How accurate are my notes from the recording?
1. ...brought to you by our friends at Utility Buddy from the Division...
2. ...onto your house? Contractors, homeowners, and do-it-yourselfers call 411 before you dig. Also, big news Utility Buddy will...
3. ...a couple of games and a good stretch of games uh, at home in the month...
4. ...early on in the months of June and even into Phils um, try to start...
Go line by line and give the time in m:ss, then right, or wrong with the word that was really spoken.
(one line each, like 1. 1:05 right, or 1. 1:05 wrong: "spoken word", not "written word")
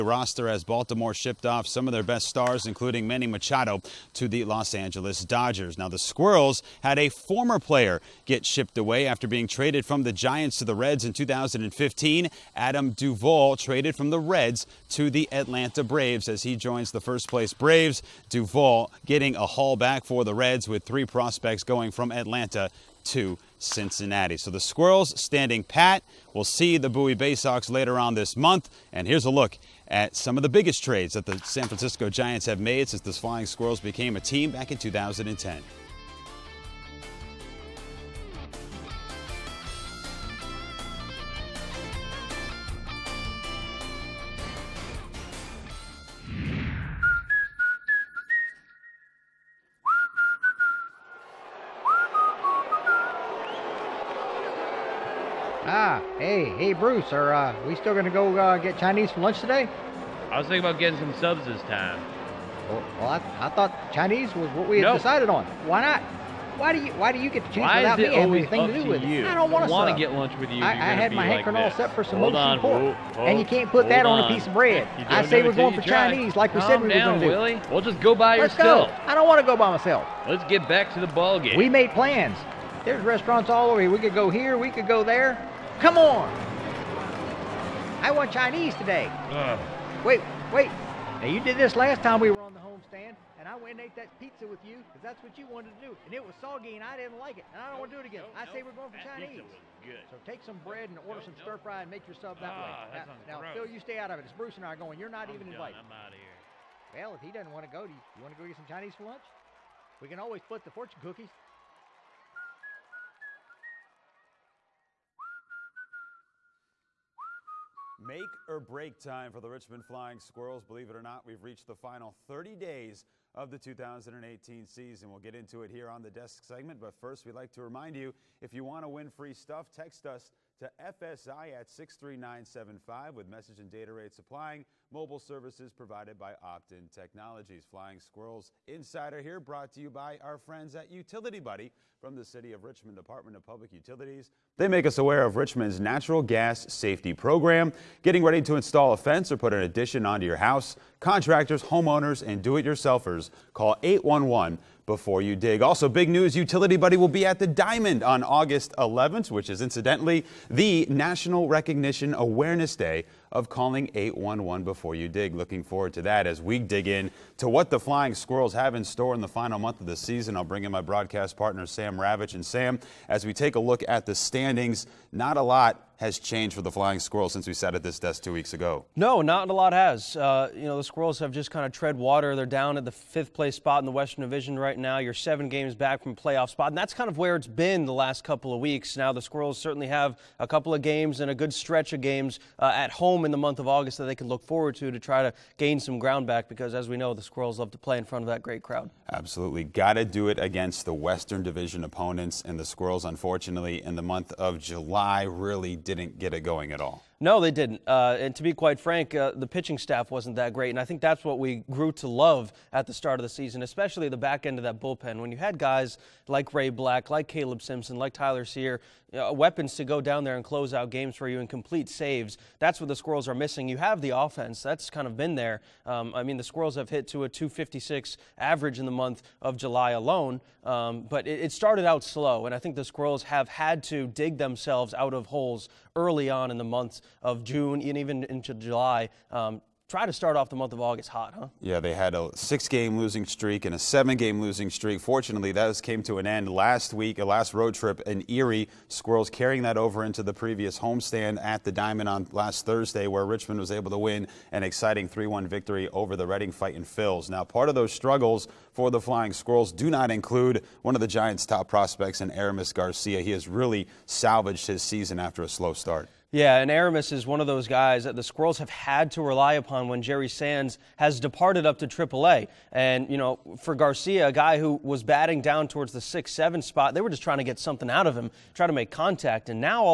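1. 2:19 wrong: "City", not "Division"
2. 2:30 wrong: "811", not "411"
3. 3:10 right
4. 3:55 wrong: "July", not "Phils".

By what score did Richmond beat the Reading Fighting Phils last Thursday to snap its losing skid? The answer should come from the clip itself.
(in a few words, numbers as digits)
3-1.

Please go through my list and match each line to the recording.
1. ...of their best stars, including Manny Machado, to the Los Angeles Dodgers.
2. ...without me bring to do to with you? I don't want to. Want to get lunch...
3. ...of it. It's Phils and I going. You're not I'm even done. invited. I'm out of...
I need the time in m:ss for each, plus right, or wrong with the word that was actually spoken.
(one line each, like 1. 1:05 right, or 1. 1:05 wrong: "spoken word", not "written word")
1. 0:01 right
2. 1:07 wrong: "anything", not "bring"
3. 1:44 wrong: "Bruce", not "Phils".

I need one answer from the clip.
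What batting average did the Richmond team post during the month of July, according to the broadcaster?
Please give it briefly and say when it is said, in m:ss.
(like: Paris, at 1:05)
.256, at 3:47.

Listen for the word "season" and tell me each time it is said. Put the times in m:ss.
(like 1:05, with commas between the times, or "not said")
2:04, 2:49, 3:33, 4:24.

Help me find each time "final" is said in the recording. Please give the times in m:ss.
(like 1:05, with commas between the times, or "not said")
2:01, 2:49.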